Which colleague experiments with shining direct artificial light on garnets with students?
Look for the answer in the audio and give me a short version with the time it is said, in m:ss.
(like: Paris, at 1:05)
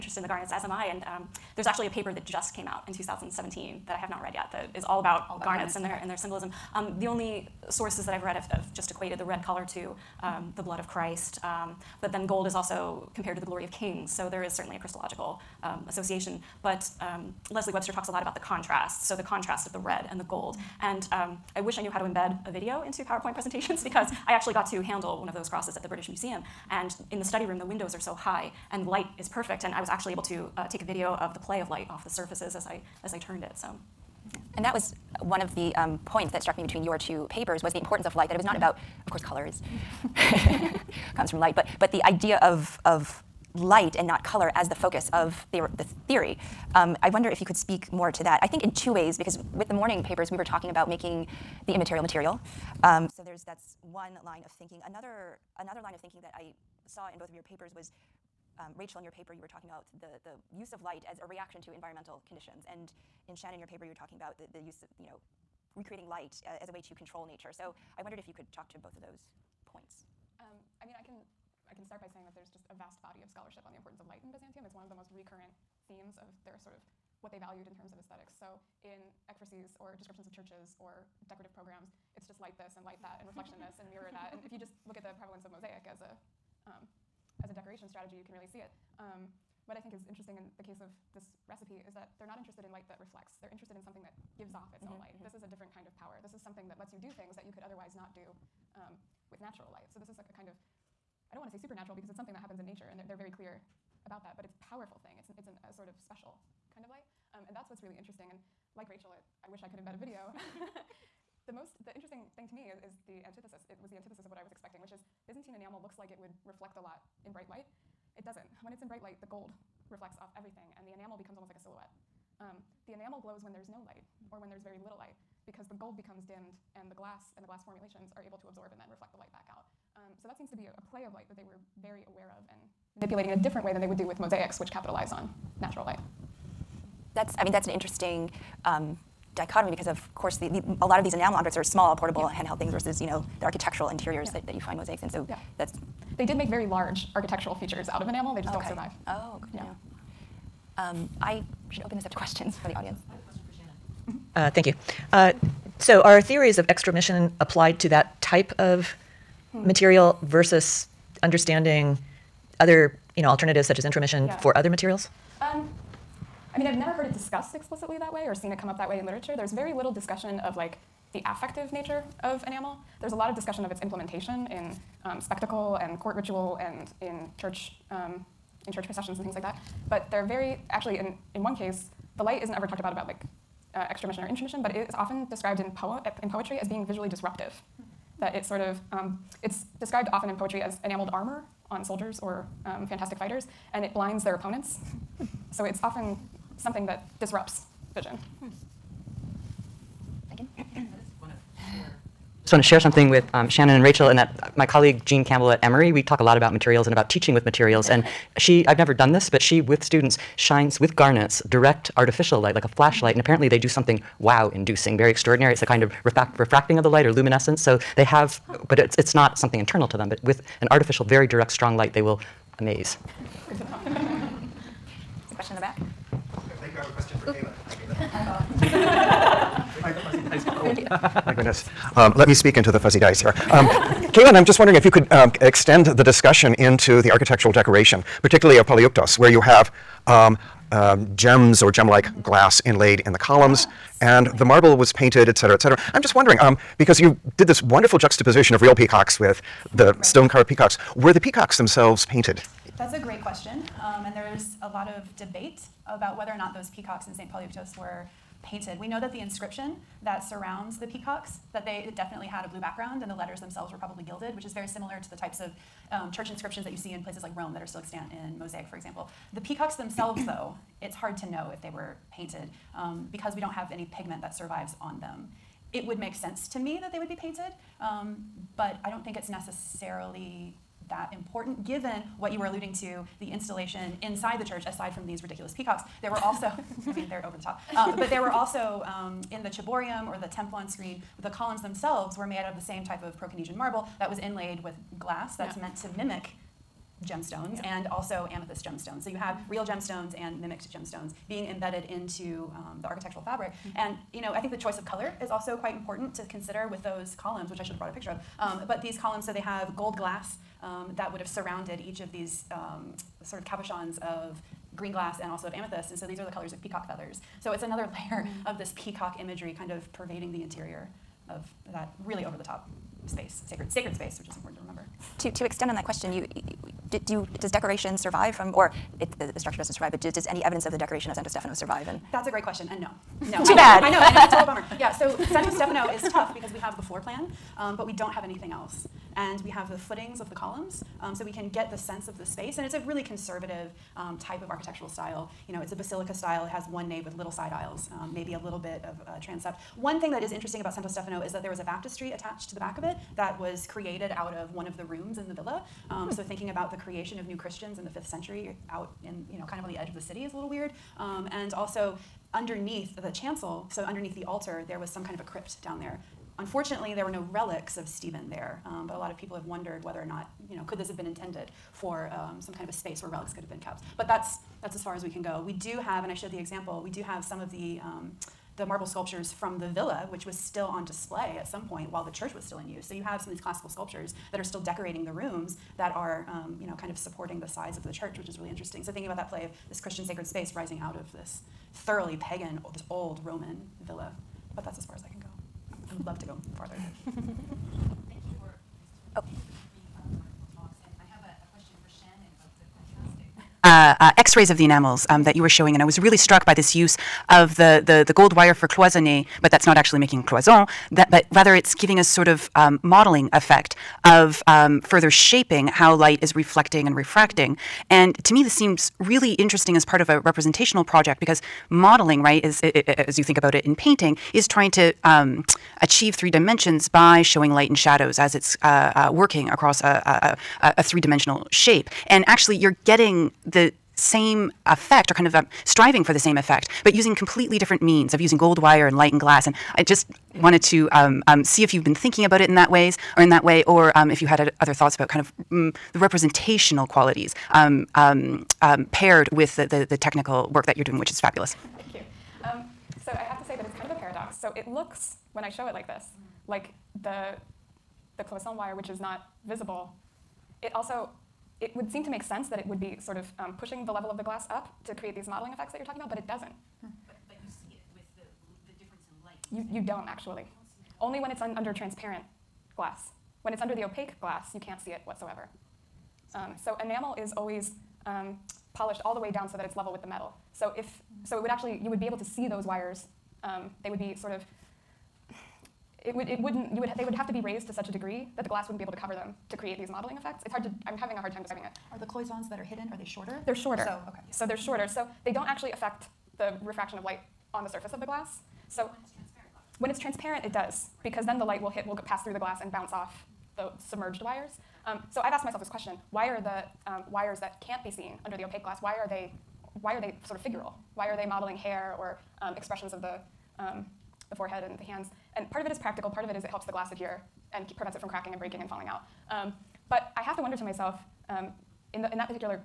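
Jean Campbell, at 3:25.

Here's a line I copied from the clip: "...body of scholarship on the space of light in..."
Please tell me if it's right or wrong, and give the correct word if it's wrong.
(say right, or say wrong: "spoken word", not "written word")
wrong: "importance", not "space".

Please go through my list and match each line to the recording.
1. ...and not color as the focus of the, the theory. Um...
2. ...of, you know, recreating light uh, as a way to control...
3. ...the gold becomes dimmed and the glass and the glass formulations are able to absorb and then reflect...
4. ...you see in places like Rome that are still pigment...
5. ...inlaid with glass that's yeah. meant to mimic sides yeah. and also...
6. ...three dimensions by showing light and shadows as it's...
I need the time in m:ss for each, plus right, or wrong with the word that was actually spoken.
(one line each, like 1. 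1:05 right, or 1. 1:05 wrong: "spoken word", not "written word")
1. 0:43 right
2. 1:04 right
3. 2:05 right
4. 4:26 wrong: "extant", not "pigment"
5. 4:54 wrong: "gemstones", not "sides"
6. 7:06 right.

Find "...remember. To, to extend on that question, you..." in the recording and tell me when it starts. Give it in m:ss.
5:24.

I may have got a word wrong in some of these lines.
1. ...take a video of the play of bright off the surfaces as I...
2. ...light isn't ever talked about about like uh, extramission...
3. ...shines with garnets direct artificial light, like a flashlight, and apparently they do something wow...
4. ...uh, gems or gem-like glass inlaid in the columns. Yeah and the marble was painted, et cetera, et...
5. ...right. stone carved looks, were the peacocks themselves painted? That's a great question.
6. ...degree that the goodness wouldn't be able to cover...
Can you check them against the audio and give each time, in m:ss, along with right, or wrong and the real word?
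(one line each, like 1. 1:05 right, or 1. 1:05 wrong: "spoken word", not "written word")
1. 0:30 wrong: "light", not "bright"
2. 3:02 right
3. 3:30 right
4. 4:00 right
5. 4:09 wrong: "peacocks", not "looks"
6. 8:07 wrong: "glass", not "goodness".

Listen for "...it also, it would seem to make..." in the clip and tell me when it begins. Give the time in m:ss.
7:40.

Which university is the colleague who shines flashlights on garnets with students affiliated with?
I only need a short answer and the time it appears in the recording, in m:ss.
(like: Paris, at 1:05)
Emory, at 3:25.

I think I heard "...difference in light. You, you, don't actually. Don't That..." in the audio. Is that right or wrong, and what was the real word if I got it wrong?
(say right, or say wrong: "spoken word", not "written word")
wrong: "Only", not "That".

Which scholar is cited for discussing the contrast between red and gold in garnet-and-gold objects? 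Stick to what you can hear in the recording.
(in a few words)
Leslie Webster.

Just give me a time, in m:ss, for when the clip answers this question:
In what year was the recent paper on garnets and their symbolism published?
0:02.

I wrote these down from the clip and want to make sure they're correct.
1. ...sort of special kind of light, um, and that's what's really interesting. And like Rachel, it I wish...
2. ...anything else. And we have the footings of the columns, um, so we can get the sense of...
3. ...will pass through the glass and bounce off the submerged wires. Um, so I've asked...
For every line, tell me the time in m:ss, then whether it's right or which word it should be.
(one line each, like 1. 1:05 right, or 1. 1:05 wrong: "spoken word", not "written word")
1. 1:45 right
2. 5:38 right
3. 8:21 right.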